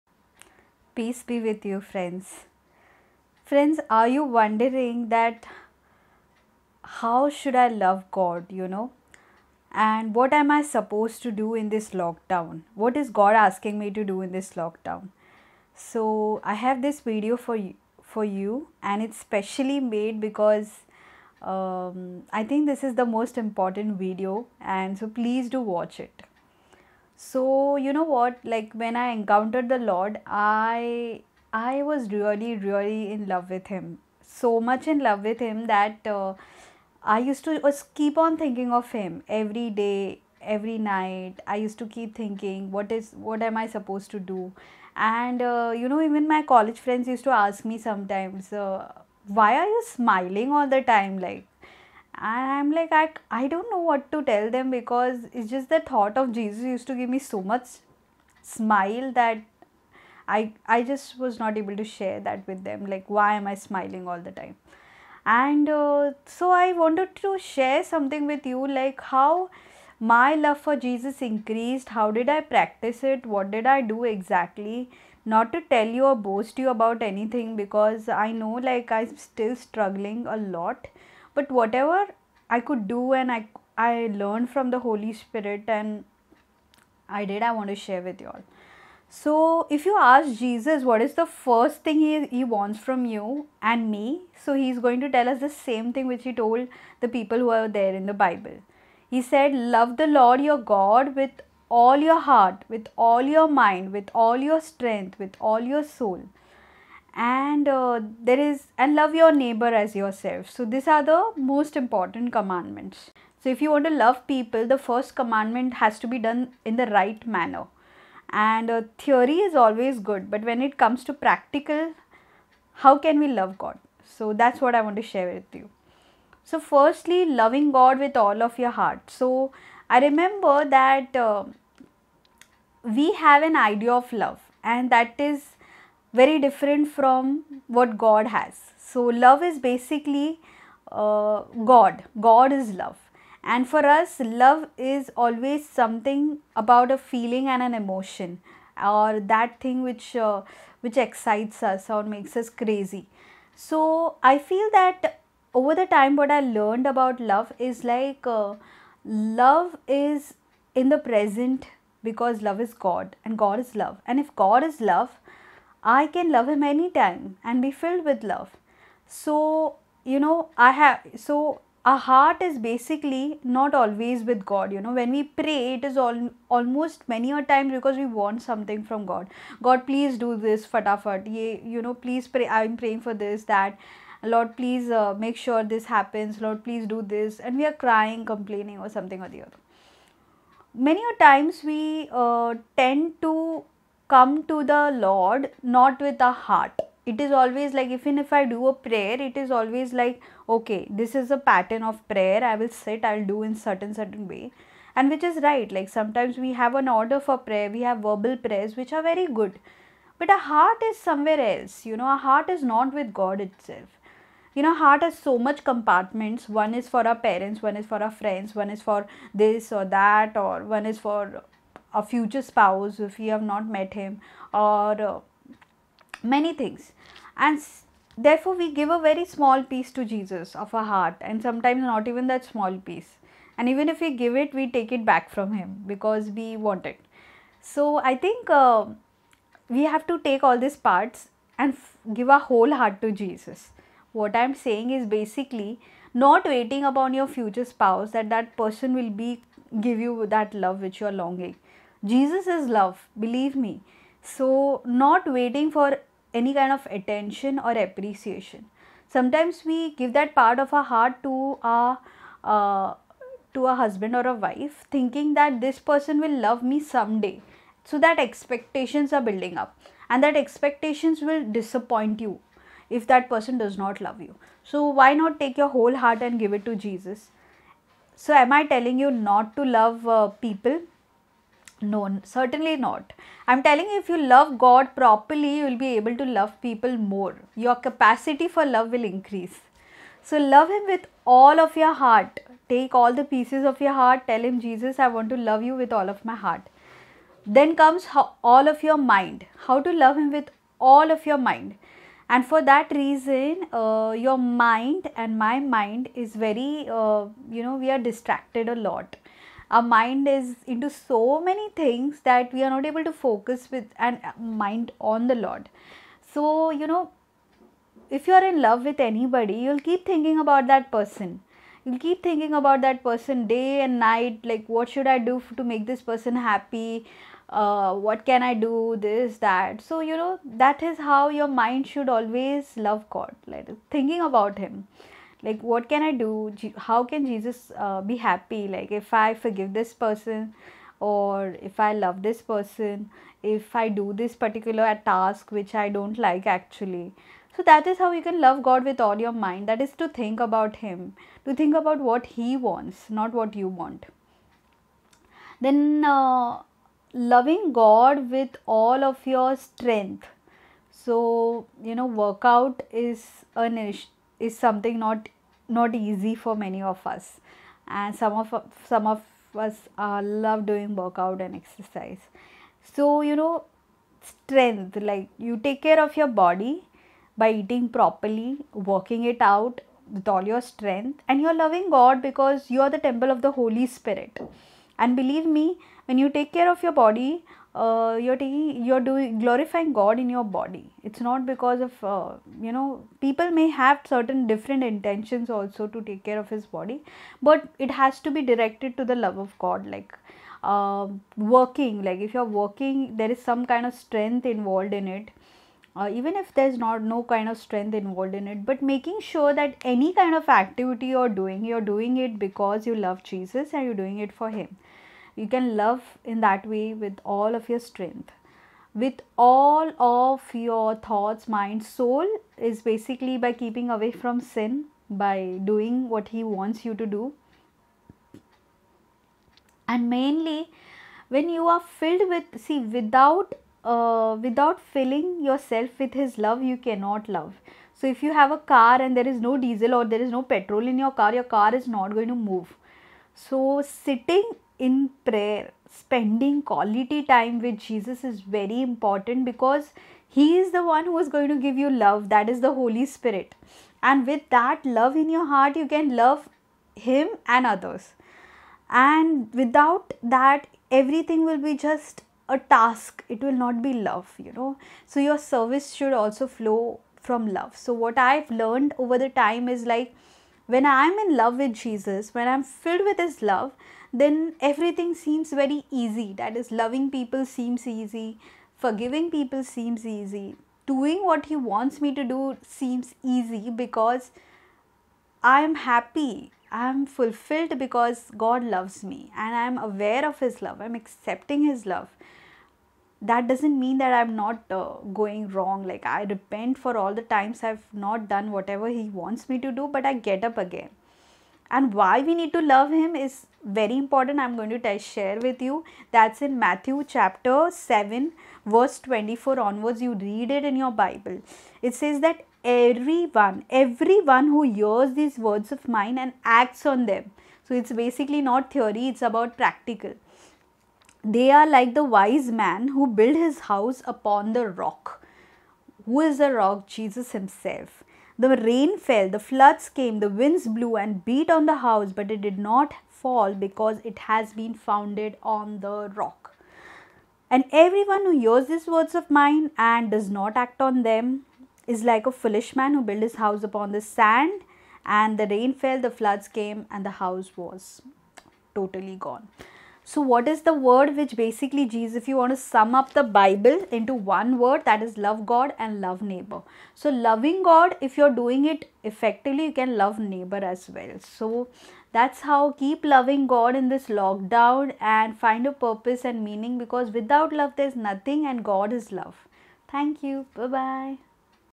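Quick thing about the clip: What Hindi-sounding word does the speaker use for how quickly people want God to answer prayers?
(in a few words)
fatafat.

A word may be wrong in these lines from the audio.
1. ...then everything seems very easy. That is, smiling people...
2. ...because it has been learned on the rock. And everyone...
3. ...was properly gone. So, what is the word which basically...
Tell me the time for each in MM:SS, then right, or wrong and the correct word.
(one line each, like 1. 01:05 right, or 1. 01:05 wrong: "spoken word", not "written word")
1. 07:54 wrong: "loving", not "smiling"
2. 08:53 wrong: "founded", not "learned"
3. 09:07 wrong: "totally", not "properly".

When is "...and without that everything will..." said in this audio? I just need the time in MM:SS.
07:39.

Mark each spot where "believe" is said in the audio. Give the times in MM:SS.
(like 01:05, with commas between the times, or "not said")
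04:13, 06:25.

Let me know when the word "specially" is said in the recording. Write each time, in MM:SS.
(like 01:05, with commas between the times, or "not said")
00:19.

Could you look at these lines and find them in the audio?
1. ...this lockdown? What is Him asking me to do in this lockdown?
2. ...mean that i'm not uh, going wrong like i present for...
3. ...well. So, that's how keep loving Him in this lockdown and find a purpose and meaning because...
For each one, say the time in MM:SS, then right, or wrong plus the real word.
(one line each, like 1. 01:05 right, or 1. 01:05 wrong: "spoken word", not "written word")
1. 00:11 wrong: "God", not "Him"
2. 08:13 wrong: "repent", not "present"
3. 09:20 wrong: "God", not "Him".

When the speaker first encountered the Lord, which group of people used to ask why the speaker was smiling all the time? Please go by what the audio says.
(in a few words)
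college friends.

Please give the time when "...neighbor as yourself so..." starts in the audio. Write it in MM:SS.
01:49.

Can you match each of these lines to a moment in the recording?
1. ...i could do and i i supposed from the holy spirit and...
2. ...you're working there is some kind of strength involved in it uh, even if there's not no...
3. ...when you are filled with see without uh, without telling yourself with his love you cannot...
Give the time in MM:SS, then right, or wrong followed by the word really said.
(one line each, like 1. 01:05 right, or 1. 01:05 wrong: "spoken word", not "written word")
1. 01:22 wrong: "learned", not "supposed"
2. 06:42 right
3. 07:11 wrong: "filling", not "telling".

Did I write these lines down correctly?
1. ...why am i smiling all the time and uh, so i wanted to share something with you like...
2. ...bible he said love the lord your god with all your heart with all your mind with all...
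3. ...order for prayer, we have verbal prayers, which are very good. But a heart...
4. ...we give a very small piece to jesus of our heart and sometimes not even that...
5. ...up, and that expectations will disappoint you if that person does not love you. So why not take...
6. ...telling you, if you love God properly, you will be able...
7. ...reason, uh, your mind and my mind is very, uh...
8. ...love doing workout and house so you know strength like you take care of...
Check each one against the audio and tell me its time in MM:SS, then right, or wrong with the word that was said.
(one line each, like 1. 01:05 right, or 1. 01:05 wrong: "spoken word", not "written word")
1. 01:03 right
2. 01:38 right
3. 03:26 right
4. 03:48 right
5. 04:29 right
6. 04:43 right
7. 05:02 right
8. 06:10 wrong: "exercise", not "house".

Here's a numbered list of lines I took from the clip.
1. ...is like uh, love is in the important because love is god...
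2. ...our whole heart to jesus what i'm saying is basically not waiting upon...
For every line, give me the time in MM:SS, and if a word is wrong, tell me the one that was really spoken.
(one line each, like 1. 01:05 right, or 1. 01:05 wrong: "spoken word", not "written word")
1. 02:37 wrong: "present", not "important"
2. 04:02 right.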